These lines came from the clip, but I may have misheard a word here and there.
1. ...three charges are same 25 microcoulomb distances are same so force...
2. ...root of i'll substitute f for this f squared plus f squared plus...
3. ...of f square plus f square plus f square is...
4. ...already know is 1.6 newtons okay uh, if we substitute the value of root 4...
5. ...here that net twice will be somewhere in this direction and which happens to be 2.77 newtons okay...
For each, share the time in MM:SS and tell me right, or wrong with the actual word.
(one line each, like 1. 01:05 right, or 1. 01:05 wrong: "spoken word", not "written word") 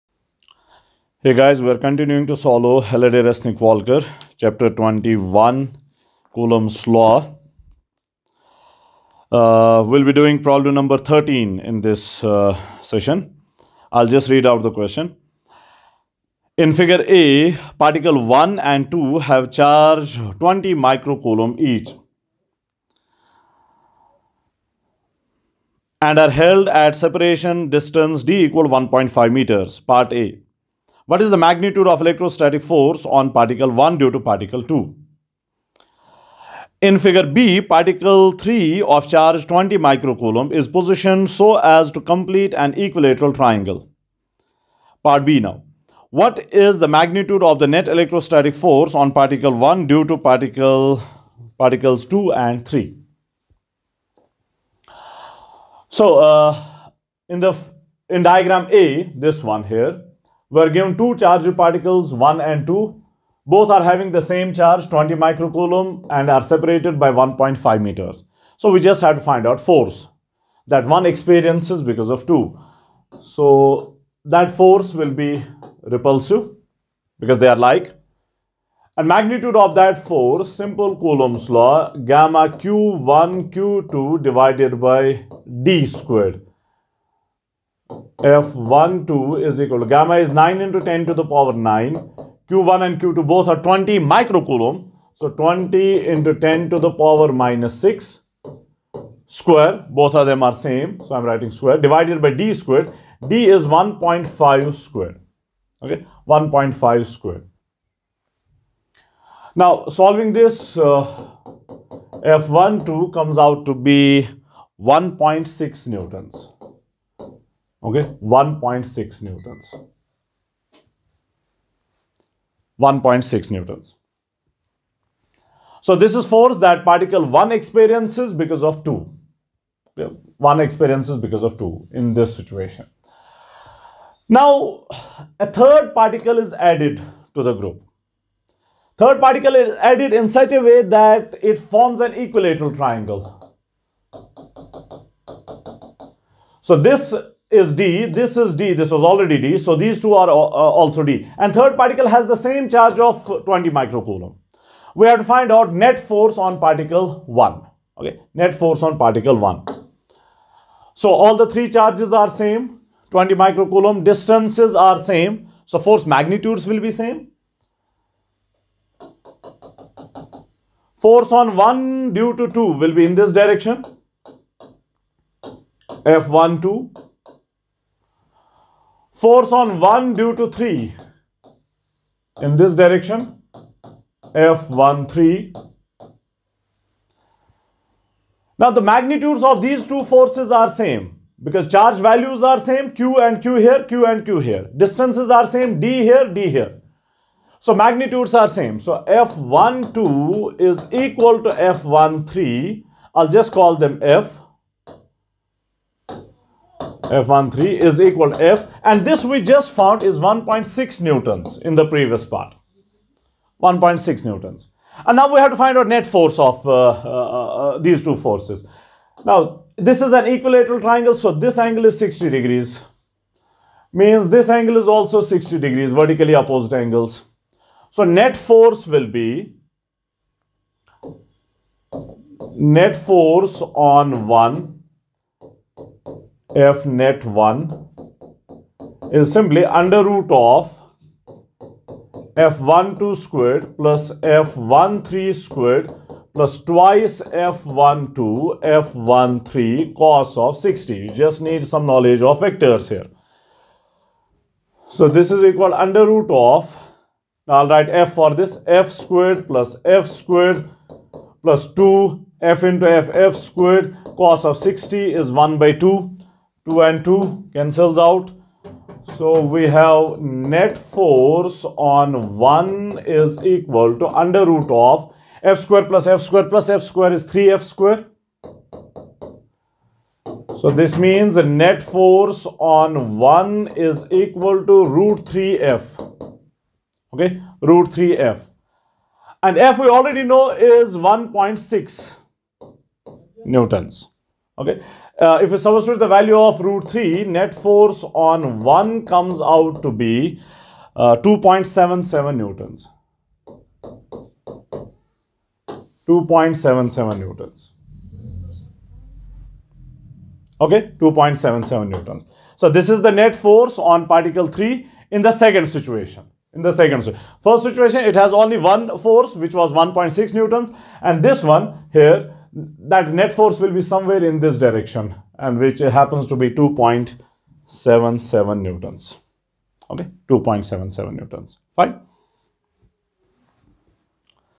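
1. 02:41 wrong: "20", not "25"
2. 04:16 wrong: "write", not "substitute"
3. 04:34 right
4. 04:49 wrong: "3", not "4"
5. 05:21 wrong: "force", not "twice".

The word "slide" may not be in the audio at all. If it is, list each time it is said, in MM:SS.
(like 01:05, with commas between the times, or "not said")
not said.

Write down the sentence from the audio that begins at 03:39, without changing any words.
Now this is an equilateral triangle so this angle is 60 degrees.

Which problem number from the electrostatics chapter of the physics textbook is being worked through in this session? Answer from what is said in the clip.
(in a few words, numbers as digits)
13.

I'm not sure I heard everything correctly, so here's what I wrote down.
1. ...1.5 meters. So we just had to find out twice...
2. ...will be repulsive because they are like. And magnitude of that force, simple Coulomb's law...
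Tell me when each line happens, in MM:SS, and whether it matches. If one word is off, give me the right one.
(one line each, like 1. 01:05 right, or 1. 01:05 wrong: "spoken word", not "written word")
1. 01:07 wrong: "force", not "twice"
2. 01:14 right.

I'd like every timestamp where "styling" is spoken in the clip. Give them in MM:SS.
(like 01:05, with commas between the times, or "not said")
not said.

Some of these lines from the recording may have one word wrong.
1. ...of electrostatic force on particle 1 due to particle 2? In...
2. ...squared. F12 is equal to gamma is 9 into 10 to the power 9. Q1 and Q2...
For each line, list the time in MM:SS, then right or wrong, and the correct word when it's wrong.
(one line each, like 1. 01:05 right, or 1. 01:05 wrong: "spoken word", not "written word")
1. 00:31 right
2. 01:25 right.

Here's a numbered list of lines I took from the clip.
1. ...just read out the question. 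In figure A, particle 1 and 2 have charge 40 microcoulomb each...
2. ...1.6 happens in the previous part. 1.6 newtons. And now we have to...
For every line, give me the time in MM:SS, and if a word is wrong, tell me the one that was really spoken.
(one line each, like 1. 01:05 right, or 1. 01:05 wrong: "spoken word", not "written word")
1. 00:14 wrong: "20", not "40"
2. 03:30 wrong: "newtons", not "happens".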